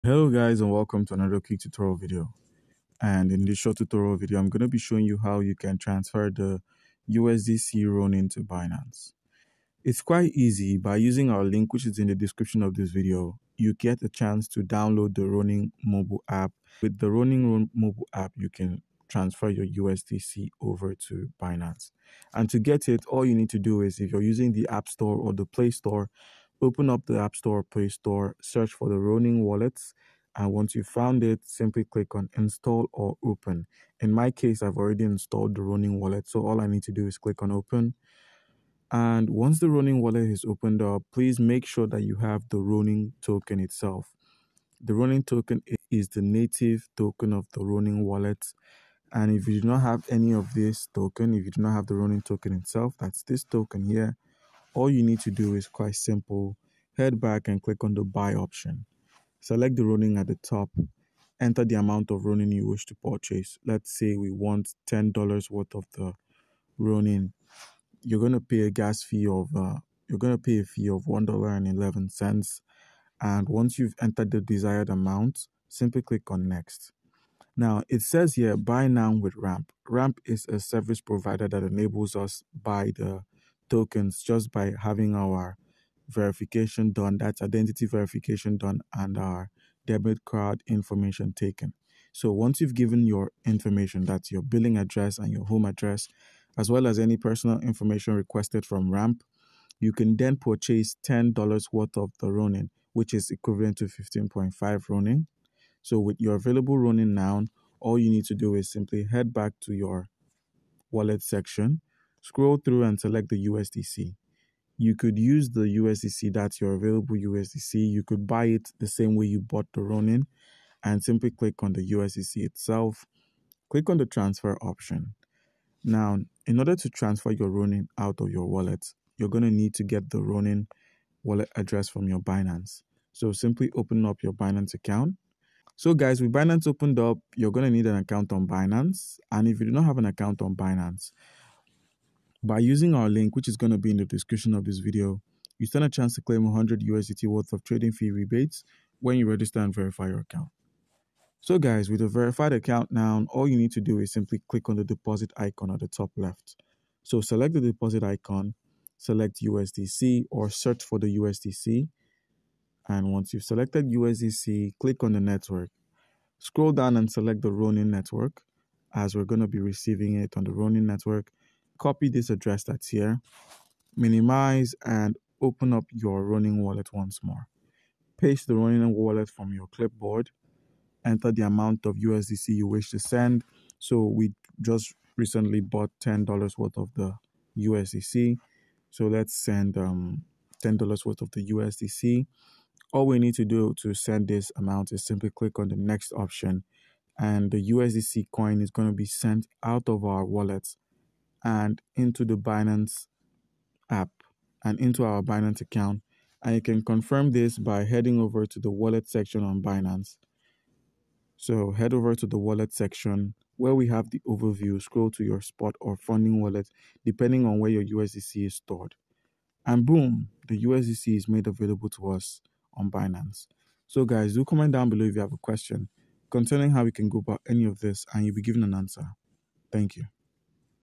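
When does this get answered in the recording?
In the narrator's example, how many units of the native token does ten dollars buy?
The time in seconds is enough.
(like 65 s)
103 s.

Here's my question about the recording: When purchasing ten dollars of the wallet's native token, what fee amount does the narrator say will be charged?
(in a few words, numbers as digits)
$1.11.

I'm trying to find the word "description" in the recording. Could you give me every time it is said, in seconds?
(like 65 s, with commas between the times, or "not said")
12 s, 144 s.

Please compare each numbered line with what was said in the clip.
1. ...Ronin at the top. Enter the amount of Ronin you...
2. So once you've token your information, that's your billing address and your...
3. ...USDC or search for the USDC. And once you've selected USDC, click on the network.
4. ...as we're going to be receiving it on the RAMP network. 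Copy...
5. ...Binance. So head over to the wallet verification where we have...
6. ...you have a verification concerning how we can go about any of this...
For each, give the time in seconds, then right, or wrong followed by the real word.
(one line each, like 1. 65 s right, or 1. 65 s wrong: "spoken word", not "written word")
1. 59 s right
2. 92 s wrong: "given", not "token"
3. 159 s right
4. 168 s wrong: "Ronin", not "RAMP"
5. 209 s wrong: "section", not "verification"
6. 225 s wrong: "question", not "verification".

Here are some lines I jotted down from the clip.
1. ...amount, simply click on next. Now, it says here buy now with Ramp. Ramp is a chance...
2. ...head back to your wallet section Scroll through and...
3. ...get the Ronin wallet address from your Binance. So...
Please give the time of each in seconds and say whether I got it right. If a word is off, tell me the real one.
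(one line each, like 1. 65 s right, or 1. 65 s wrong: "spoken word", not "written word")
1. 74 s wrong: "service", not "chance"
2. 109 s right
3. 129 s right.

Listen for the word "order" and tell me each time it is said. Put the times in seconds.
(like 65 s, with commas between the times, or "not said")
126 s.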